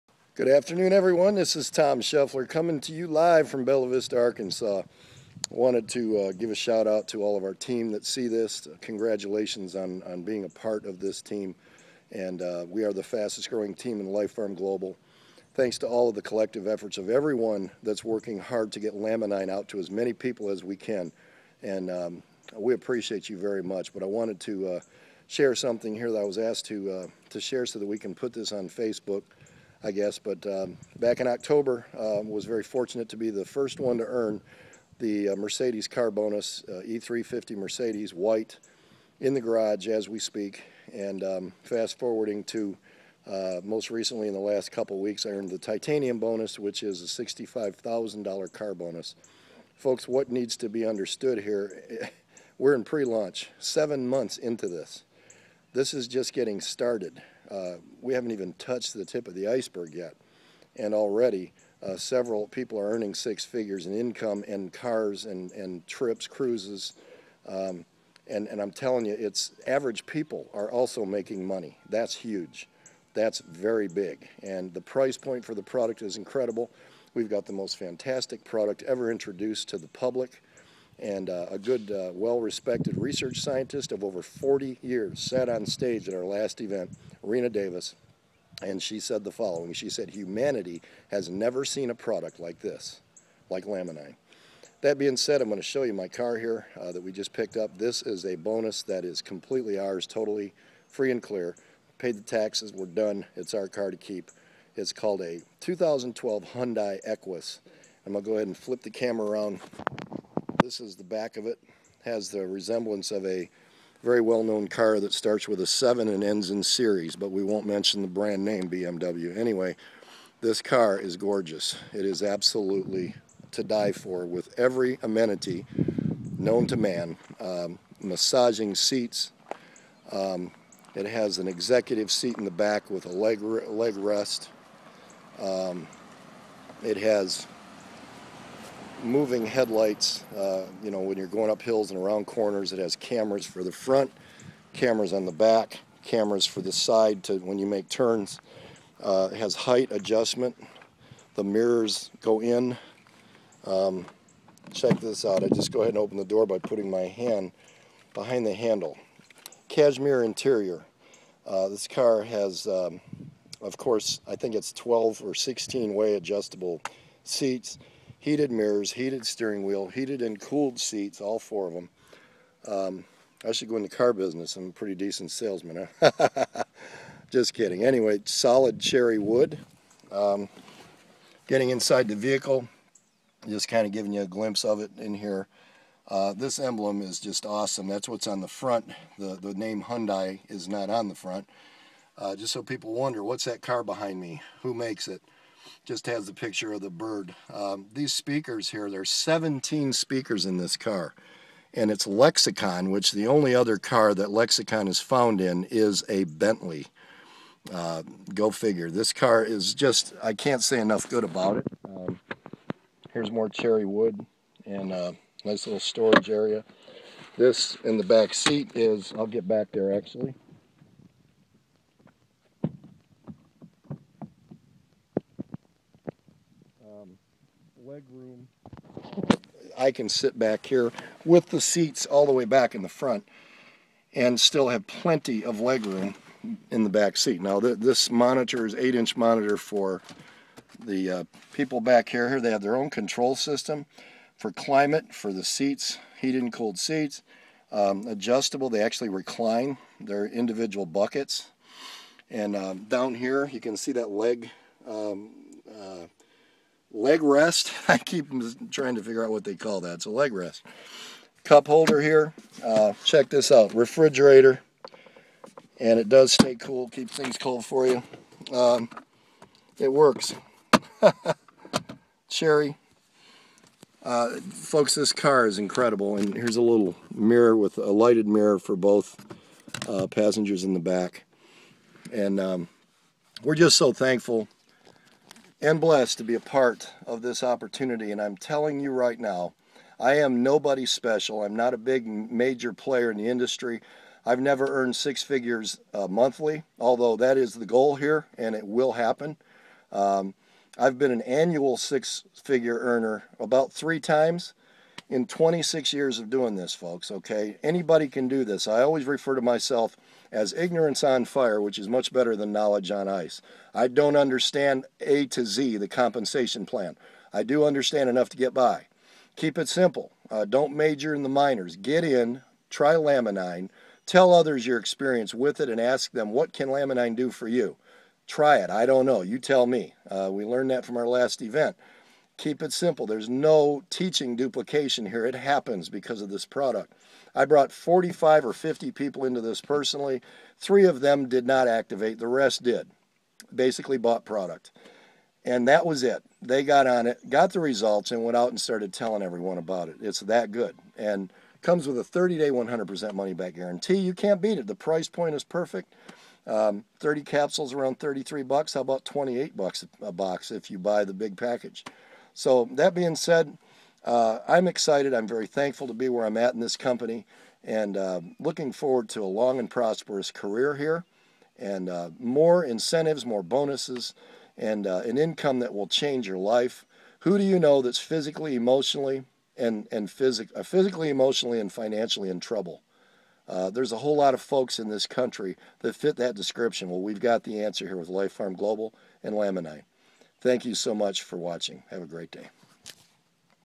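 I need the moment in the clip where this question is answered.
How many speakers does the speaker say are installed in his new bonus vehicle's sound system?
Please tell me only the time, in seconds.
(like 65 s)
199 s.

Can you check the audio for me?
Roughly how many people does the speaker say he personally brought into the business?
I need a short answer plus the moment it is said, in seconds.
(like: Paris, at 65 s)
45 or 50, at 337 s.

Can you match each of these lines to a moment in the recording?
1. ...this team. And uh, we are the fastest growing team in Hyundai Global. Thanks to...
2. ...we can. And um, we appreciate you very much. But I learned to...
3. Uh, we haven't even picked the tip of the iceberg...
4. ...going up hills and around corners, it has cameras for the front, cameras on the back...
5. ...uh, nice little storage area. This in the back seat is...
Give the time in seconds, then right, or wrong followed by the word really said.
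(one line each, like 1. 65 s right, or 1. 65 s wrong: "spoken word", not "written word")
1. 10 s wrong: "LifePharm", not "Hyundai"
2. 20 s wrong: "wanted", not "learned"
3. 57 s wrong: "touched", not "picked"
4. 141 s right
5. 214 s right.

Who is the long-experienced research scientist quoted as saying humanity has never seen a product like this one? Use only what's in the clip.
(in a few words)
Rena Davis.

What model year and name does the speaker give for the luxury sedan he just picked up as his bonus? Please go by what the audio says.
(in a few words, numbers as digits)
2012 Hyundai Equus.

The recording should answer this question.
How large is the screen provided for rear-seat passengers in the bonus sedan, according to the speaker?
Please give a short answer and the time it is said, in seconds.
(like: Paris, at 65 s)
8-inch, at 238 s.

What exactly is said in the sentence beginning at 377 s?
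Who do you know that's physically, emotionally, and, and phys- uh, physically, emotionally, and financially in trouble?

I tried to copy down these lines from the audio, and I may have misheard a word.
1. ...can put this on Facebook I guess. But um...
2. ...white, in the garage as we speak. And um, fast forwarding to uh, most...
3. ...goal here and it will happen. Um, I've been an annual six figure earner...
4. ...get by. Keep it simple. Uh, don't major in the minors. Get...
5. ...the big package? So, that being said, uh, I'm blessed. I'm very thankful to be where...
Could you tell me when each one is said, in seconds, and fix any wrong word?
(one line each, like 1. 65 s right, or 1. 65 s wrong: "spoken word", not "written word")
1. 27 s right
2. 38 s right
3. 297 s right
4. 318 s right
5. 361 s wrong: "excited", not "blessed".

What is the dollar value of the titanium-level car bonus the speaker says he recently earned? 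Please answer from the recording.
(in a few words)
$65,000.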